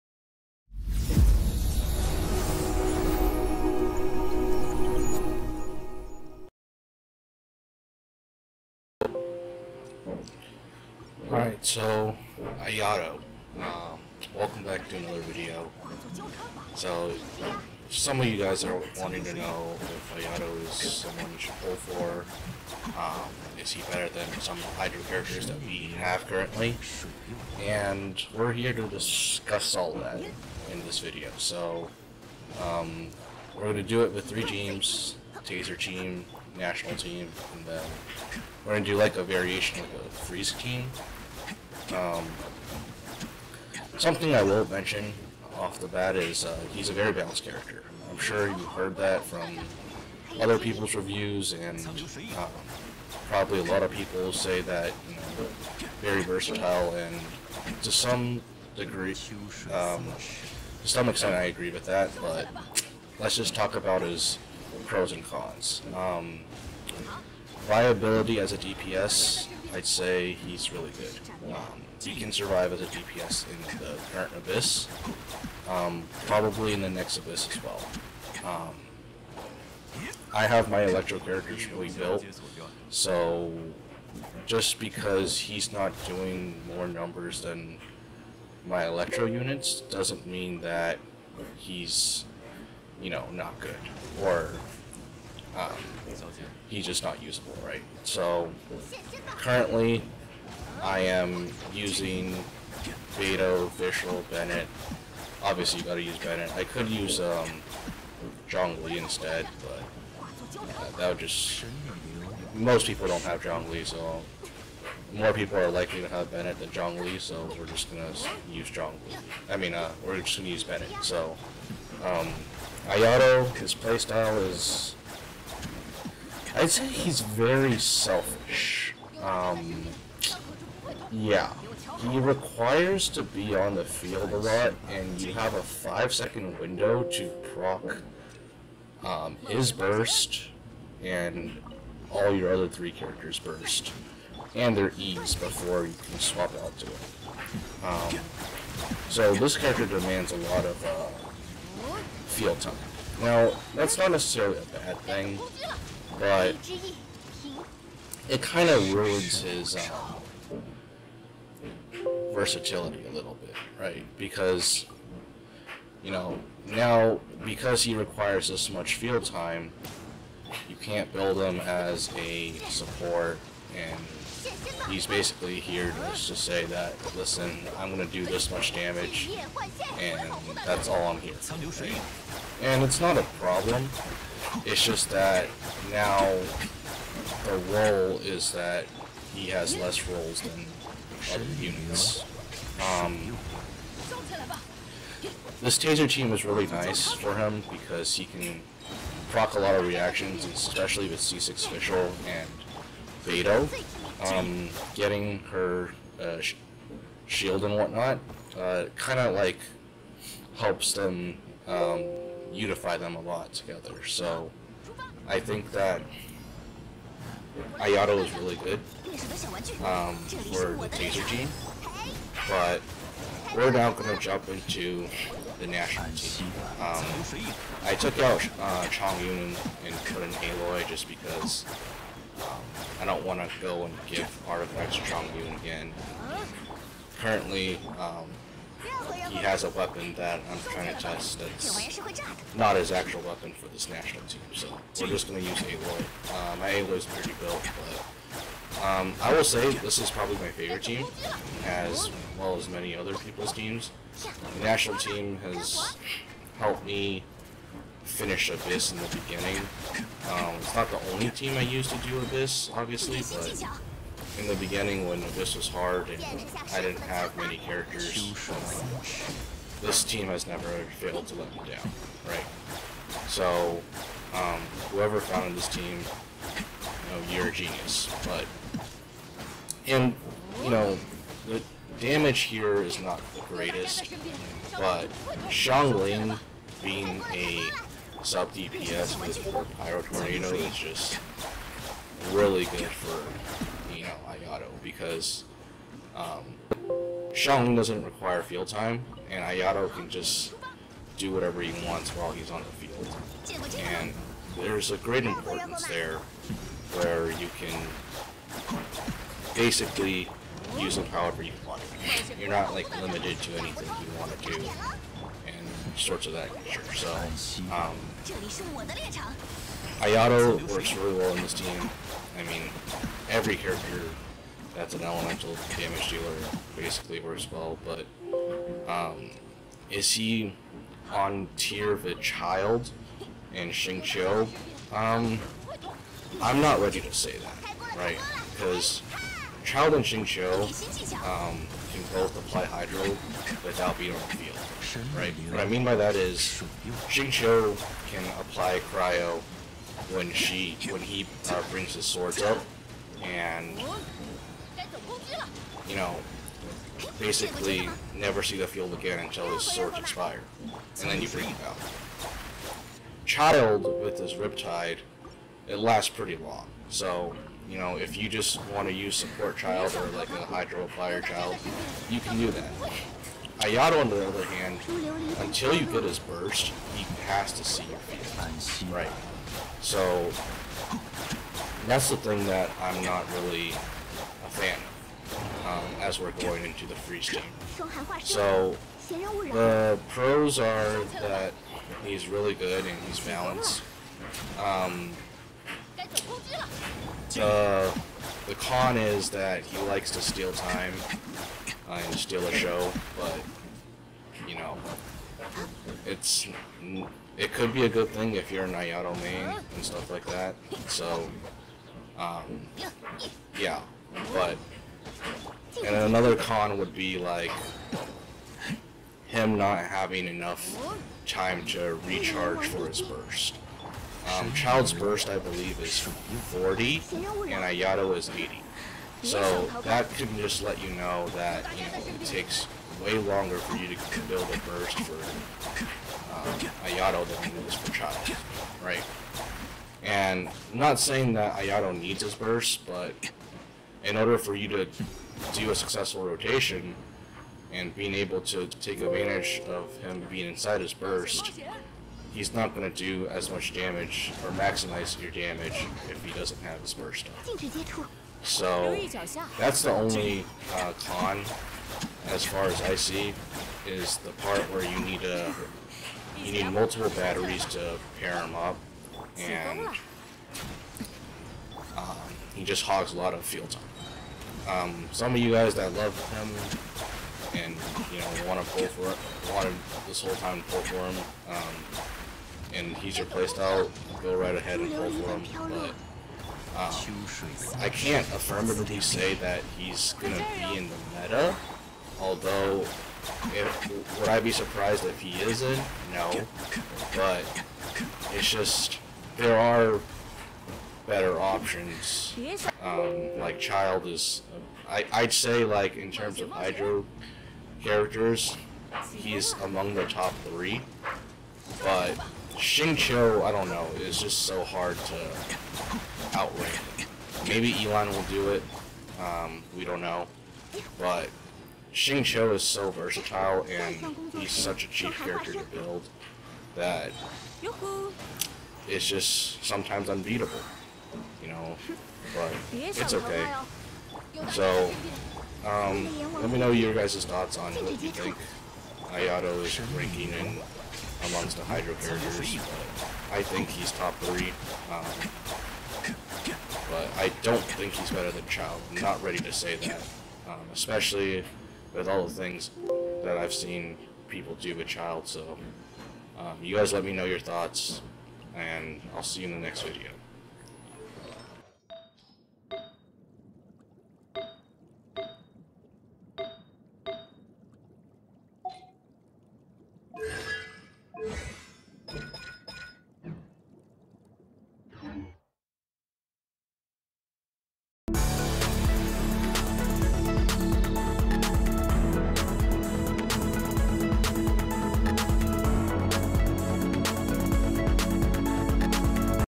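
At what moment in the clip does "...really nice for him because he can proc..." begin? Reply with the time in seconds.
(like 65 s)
196 s.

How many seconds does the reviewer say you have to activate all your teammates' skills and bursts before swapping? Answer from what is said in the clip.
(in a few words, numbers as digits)
5.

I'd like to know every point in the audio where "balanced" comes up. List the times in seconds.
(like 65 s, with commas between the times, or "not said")
47 s, 393 s.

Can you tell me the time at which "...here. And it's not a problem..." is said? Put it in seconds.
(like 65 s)
181 s.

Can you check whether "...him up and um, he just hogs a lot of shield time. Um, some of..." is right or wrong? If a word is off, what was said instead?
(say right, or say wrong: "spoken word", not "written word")
wrong: "field", not "shield".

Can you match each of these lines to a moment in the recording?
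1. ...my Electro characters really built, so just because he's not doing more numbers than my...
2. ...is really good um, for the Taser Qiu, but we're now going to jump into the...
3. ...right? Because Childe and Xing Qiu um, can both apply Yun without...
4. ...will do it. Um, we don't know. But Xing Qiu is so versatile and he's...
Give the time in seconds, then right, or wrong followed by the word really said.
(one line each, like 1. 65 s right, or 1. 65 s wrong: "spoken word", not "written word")
1. 80 s right
2. 218 s wrong: "Gene", not "Qiu"
3. 337 s wrong: "Hydro", not "Yun"
4. 518 s right.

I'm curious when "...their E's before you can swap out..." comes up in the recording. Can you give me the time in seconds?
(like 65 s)
144 s.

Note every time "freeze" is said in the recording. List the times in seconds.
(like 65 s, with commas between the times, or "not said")
40 s, 386 s.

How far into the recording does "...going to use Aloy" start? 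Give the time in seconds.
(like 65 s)
245 s.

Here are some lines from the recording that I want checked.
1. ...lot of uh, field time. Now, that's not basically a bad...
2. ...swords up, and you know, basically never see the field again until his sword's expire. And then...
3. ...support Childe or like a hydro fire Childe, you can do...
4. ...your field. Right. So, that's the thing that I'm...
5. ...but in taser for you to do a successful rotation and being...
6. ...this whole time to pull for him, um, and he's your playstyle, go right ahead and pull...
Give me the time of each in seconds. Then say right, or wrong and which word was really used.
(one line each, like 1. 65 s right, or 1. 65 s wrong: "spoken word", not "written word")
1. 150 s wrong: "necessarily", not "basically"
2. 352 s right
3. 369 s right
4. 377 s right
5. 442 s wrong: "order", not "taser"
6. 480 s right.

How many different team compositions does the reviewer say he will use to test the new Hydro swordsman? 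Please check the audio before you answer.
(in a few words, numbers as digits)
3.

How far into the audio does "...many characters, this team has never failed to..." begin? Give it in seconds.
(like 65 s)
267 s.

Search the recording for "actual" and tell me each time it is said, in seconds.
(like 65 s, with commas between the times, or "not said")
242 s.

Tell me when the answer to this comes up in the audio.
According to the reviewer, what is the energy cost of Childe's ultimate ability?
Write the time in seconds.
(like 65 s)
425 s.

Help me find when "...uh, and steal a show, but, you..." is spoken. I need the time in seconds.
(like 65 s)
401 s.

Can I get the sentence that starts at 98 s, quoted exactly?
So currently, I am using Beidou, Fischl, Bennett.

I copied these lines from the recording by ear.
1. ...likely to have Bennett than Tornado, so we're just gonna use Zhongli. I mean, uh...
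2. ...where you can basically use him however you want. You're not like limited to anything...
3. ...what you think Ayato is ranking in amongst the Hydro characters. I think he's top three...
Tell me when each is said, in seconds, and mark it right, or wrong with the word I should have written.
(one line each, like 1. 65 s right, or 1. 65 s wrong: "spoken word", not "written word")
1. 115 s wrong: "Zhongli", not "Tornado"
2. 306 s right
3. 537 s right.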